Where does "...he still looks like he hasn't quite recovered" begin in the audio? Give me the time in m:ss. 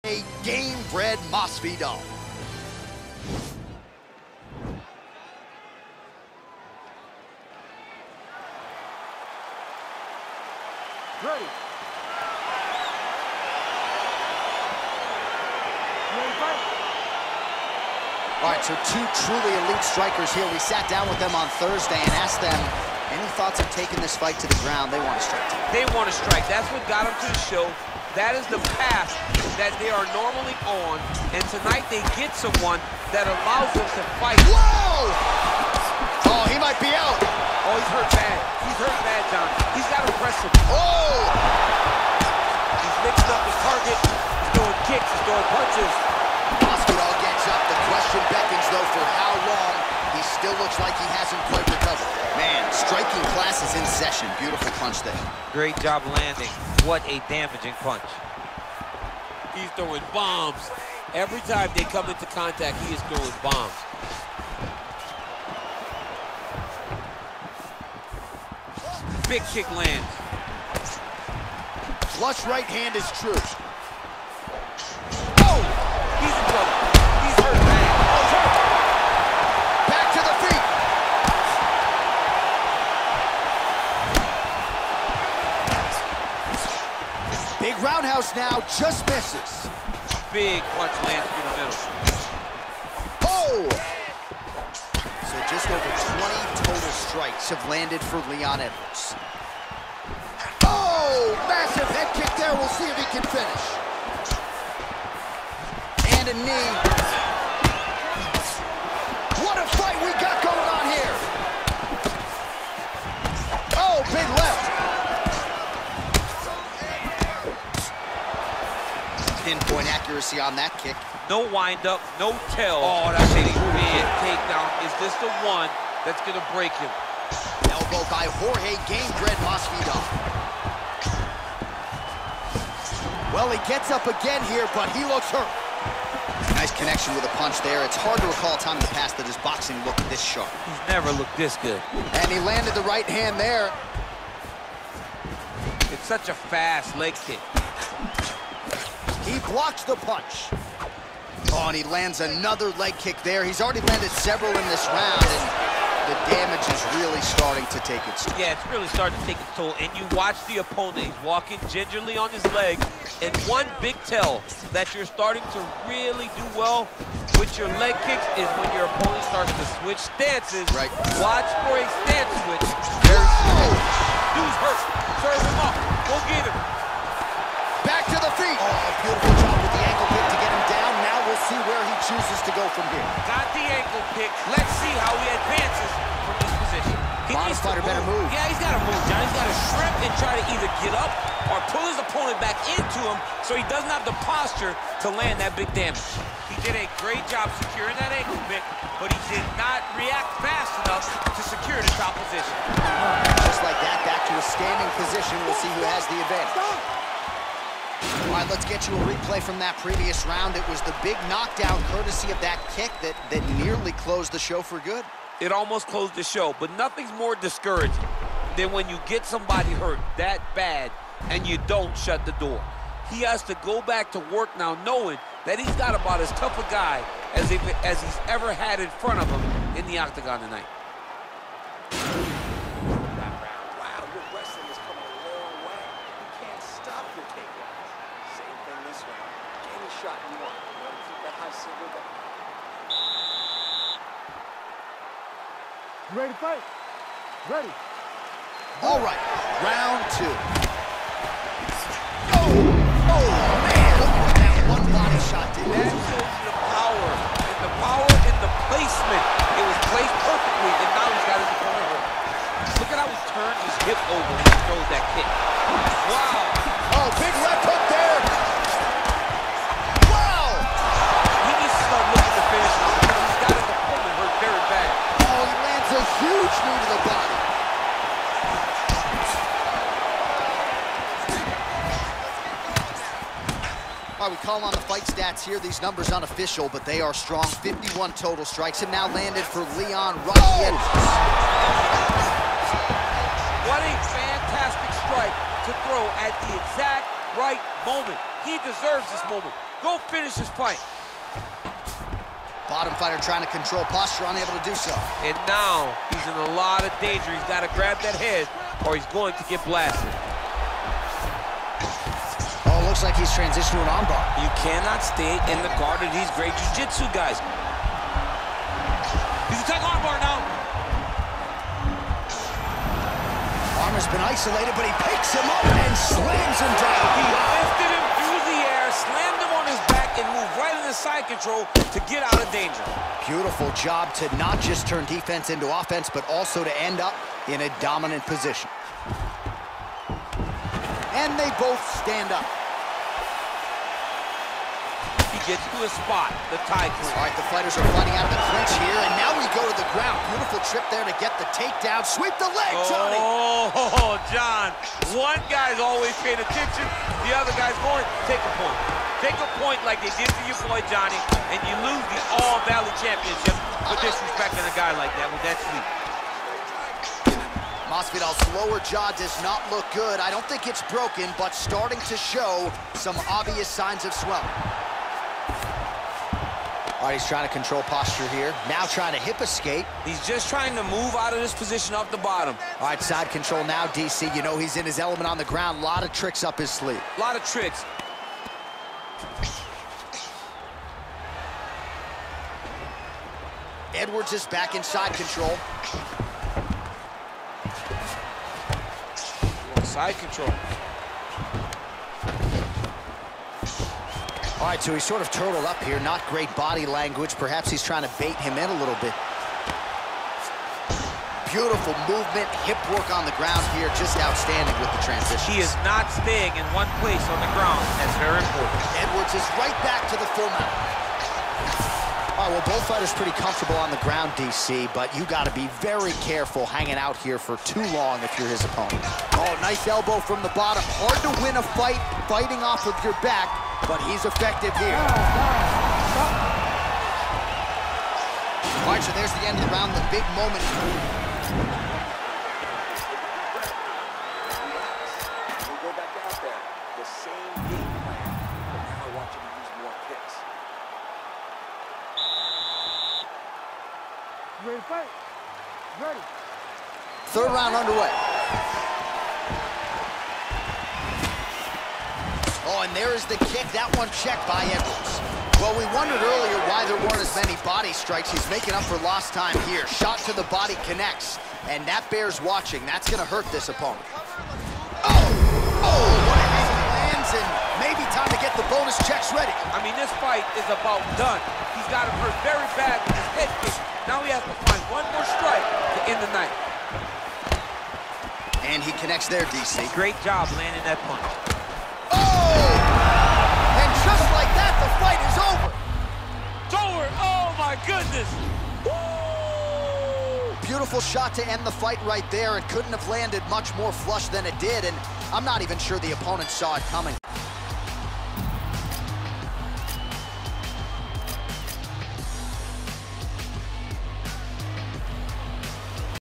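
0:50.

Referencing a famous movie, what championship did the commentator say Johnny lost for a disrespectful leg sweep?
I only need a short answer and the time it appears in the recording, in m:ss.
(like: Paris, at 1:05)
All Valley Championship, at 6:02.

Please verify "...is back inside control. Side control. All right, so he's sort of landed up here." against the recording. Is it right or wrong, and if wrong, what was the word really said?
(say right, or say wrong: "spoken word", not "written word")
wrong: "turtled", not "landed".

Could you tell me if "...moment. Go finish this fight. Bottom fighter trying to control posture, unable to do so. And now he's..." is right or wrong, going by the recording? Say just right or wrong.
right.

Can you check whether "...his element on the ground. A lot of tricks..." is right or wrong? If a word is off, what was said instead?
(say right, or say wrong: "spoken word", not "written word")
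right.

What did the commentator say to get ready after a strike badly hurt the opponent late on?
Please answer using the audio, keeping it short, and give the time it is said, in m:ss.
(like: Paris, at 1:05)
bonus checks, at 7:58.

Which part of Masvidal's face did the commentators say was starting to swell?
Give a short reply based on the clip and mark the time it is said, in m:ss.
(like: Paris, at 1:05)
lower jaw, at 6:08.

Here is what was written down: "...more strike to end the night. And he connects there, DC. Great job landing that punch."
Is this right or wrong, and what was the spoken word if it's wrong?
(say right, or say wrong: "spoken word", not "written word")
right.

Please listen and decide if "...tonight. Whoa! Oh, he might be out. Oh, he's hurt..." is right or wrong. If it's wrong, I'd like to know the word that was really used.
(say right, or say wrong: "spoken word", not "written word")
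wrong: "fight", not "tonight".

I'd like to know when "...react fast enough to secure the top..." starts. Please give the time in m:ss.
3:19.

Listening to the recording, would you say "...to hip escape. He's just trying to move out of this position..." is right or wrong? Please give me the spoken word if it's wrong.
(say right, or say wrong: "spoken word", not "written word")
right.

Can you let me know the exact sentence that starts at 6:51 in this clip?
Beautiful movement, hip work on the ground here.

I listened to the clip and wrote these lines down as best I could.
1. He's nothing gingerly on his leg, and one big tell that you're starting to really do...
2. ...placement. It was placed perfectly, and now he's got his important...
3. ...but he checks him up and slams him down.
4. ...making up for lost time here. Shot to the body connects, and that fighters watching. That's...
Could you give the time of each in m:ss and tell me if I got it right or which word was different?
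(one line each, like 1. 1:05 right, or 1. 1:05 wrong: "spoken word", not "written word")
1. 2:41 wrong: "walking", not "nothing"
2. 4:18 wrong: "opponent", not "important"
3. 5:24 wrong: "picks", not "checks"
4. 7:48 wrong: "bears", not "fighters".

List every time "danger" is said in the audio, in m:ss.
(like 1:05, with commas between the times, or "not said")
5:07, 5:32.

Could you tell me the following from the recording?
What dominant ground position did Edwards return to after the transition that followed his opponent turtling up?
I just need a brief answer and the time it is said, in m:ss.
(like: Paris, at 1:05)
full mount, at 7:00.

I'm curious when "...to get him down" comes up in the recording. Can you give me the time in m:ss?
3:00.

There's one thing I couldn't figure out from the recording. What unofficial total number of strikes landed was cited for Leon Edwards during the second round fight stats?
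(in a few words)
51.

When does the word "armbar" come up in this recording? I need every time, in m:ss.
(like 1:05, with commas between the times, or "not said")
5:13, 5:19.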